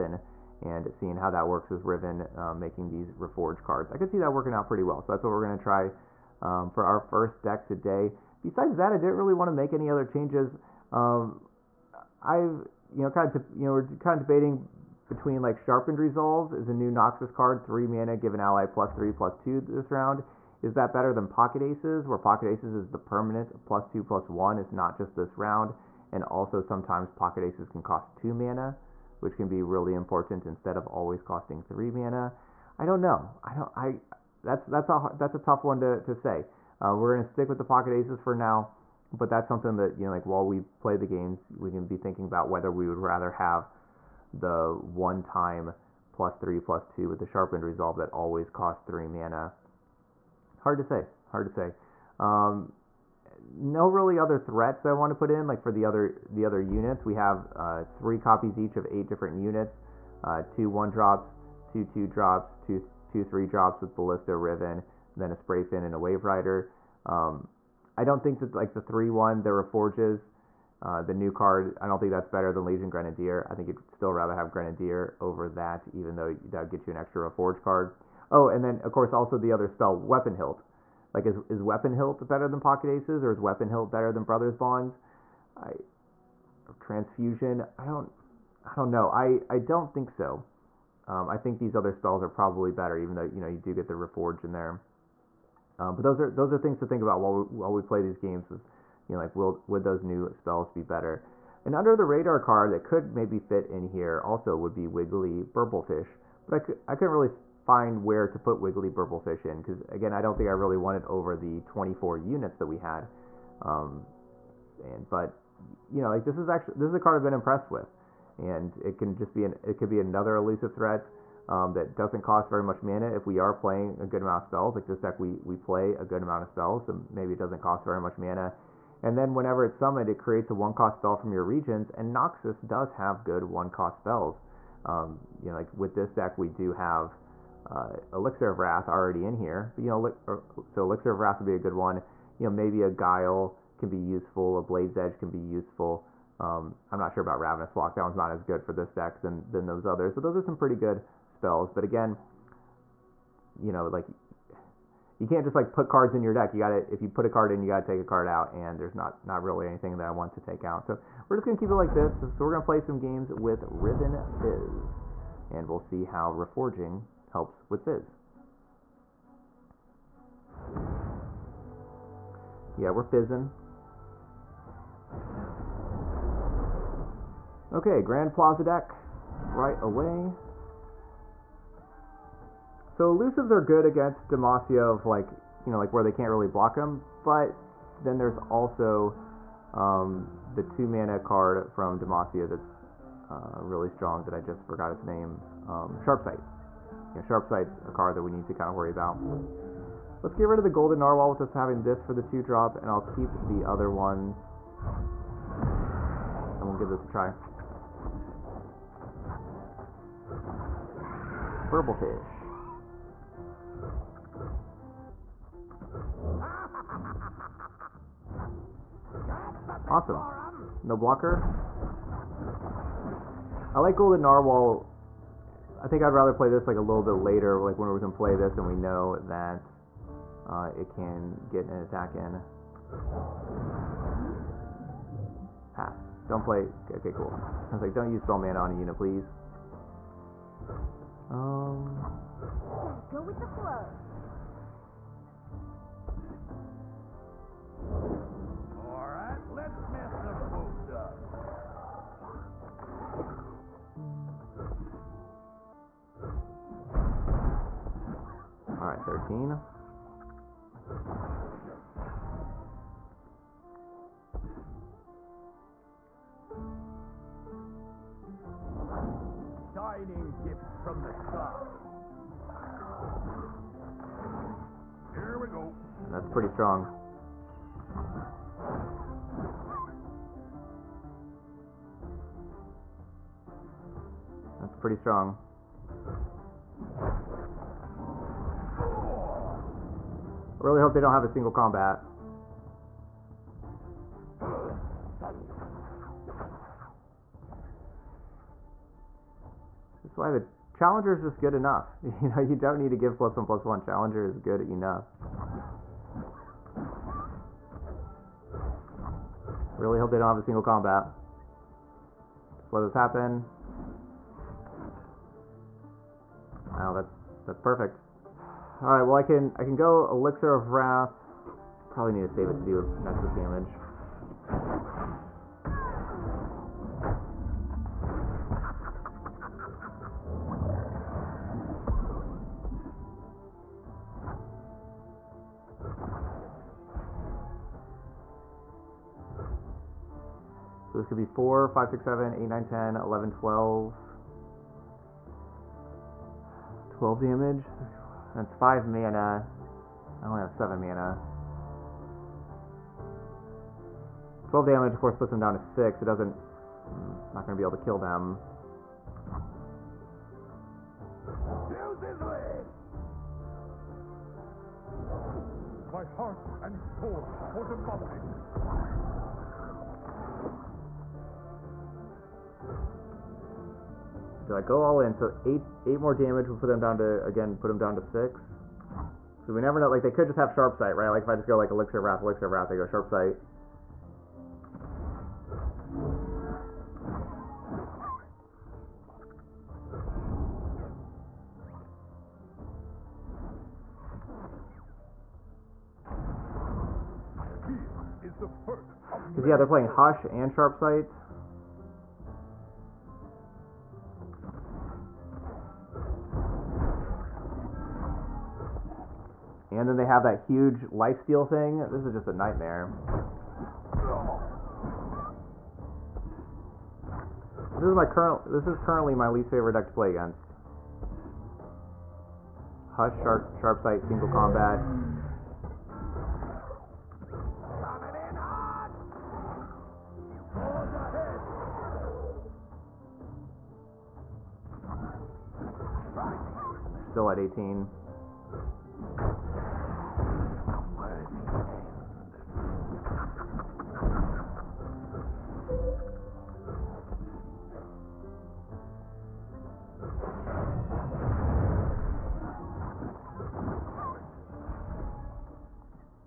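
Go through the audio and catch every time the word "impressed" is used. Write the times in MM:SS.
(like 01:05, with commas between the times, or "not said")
01:57.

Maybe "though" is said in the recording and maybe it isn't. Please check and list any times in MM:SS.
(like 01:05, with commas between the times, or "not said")
01:16, 01:33.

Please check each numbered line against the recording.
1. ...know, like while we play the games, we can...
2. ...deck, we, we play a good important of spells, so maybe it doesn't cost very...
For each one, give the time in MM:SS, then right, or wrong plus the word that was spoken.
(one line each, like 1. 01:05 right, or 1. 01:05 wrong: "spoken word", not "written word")
1. 00:40 right
2. 02:05 wrong: "amount", not "important".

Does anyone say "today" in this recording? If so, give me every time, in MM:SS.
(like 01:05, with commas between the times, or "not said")
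00:07.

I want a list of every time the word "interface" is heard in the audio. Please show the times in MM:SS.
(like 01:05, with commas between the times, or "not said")
not said.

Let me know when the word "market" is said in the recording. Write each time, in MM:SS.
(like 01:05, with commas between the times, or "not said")
not said.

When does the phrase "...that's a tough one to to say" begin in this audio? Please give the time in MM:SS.
00:35.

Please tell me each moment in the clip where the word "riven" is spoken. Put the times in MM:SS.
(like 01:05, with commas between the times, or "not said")
00:01, 01:04, 02:43.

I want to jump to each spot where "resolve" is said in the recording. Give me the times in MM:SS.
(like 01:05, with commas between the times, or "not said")
00:15, 00:47.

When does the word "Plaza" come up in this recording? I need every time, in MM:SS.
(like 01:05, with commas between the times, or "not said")
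02:58.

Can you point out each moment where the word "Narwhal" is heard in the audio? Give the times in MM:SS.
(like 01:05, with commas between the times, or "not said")
03:21, 03:44.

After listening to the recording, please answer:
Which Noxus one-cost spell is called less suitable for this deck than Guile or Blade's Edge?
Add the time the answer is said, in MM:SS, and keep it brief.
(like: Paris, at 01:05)
Ravenous Flock, at 02:27.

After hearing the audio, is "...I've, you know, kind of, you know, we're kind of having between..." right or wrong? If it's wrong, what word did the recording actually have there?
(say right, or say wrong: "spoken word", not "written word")
wrong: "debating", not "having".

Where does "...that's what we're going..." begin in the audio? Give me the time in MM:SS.
00:05.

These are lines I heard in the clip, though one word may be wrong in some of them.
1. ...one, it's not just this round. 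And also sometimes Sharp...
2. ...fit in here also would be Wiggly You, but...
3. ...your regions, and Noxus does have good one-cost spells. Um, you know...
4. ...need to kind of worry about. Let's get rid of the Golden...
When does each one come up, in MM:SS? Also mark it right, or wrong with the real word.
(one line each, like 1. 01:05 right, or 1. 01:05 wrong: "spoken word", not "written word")
1. 00:24 wrong: "Pocket", not "Sharp"
2. 01:43 wrong: "Burblefish", not "You"
3. 02:11 right
4. 03:18 right.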